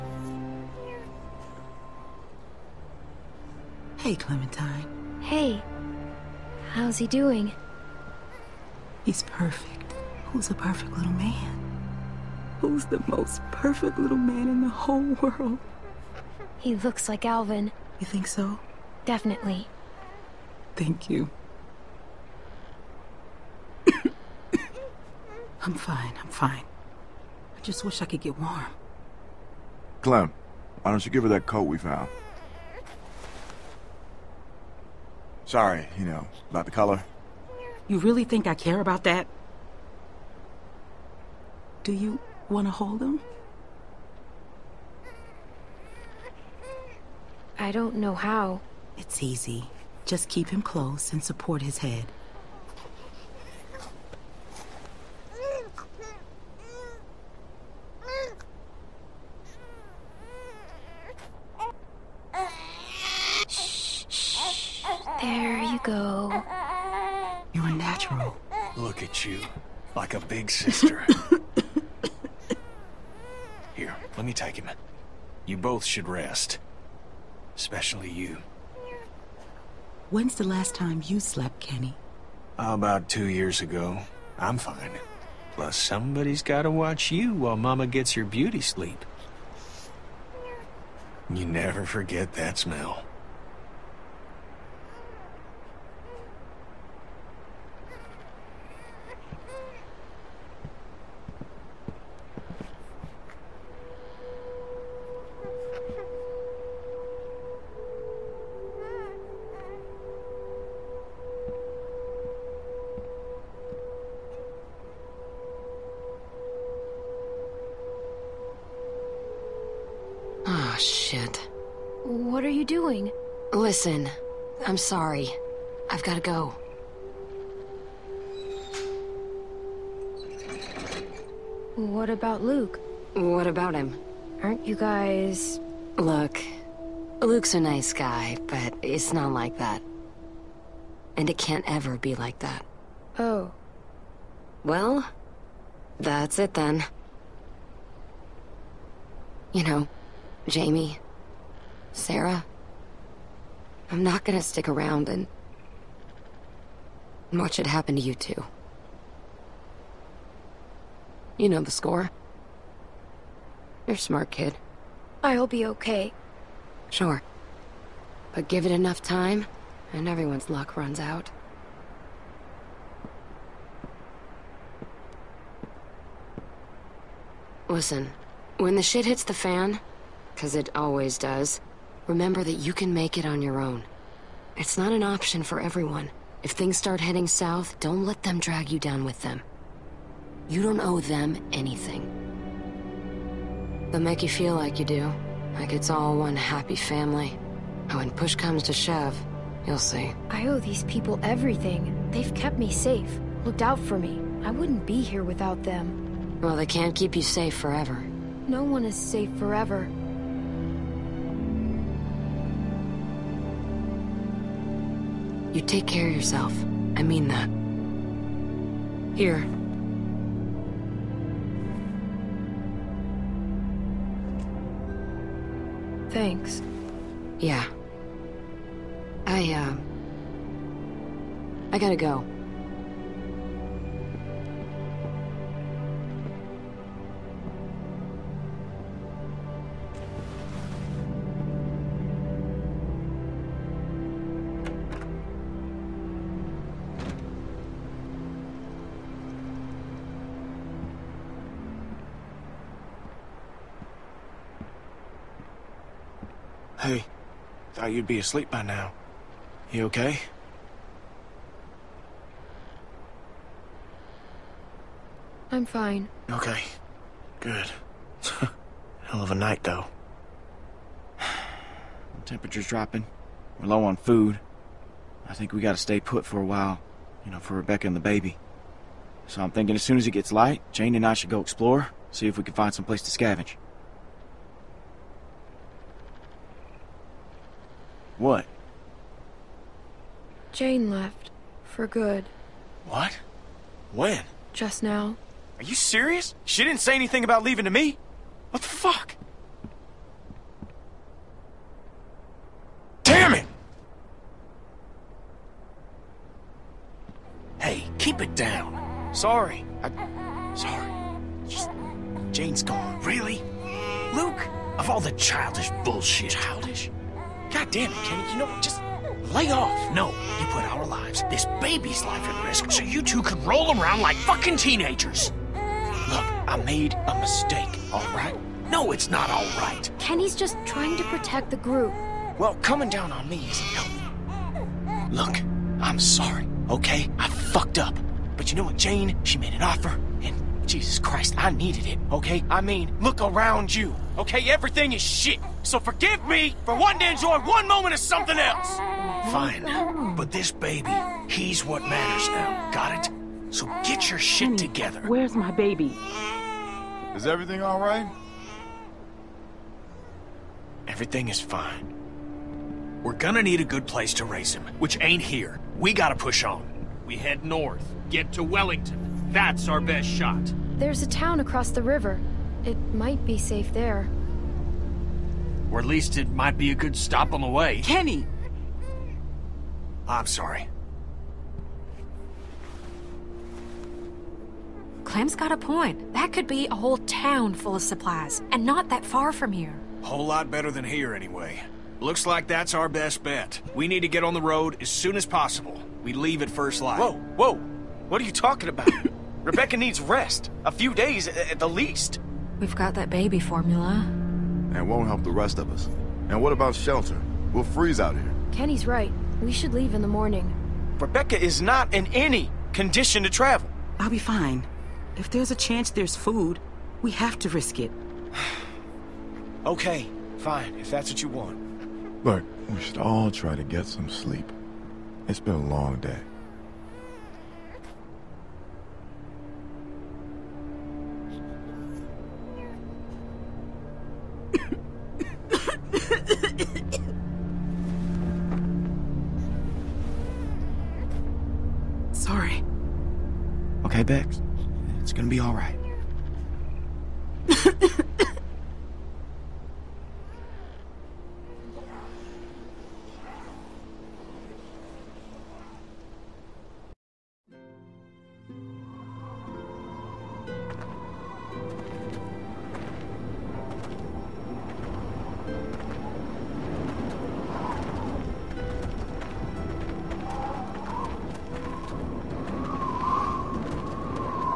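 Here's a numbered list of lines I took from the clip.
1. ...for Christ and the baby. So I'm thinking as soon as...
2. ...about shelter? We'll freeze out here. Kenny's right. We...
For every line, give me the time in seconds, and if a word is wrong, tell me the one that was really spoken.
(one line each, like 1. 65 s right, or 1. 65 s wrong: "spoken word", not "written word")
1. 277 s wrong: "Rebecca", not "Christ"
2. 406 s right.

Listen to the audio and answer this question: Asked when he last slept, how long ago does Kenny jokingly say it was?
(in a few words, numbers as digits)
About two years ago.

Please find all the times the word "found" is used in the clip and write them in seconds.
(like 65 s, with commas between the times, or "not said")
31 s.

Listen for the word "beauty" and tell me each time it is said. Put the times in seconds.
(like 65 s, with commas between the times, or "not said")
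88 s.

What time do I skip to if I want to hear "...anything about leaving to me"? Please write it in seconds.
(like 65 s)
296 s.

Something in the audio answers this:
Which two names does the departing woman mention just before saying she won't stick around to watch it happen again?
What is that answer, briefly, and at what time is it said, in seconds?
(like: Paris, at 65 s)
Jamie, Sarah, at 150 s.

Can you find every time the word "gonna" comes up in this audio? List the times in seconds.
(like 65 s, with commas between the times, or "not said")
154 s, 363 s, 445 s.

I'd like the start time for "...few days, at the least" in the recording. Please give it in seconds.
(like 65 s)
400 s.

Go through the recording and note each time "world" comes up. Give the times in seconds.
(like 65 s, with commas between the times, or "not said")
15 s.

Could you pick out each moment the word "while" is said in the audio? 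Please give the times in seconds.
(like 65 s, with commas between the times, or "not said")
87 s, 276 s.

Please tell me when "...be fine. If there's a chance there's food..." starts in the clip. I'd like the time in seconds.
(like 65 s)
414 s.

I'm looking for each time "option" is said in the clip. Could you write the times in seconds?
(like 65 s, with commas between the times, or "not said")
185 s.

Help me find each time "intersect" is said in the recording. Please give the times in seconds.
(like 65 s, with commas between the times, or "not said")
not said.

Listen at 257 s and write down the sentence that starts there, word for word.
Thought you'd be asleep by now.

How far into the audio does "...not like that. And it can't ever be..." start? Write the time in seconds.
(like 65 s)
139 s.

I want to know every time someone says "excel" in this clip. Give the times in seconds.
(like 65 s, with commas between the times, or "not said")
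not said.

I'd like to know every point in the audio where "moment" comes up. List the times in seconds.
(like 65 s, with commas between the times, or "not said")
347 s.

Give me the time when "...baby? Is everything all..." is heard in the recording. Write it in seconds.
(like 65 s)
355 s.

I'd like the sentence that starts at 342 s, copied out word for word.
I mean, look around you, okay?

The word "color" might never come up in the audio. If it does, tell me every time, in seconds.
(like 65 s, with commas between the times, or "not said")
36 s.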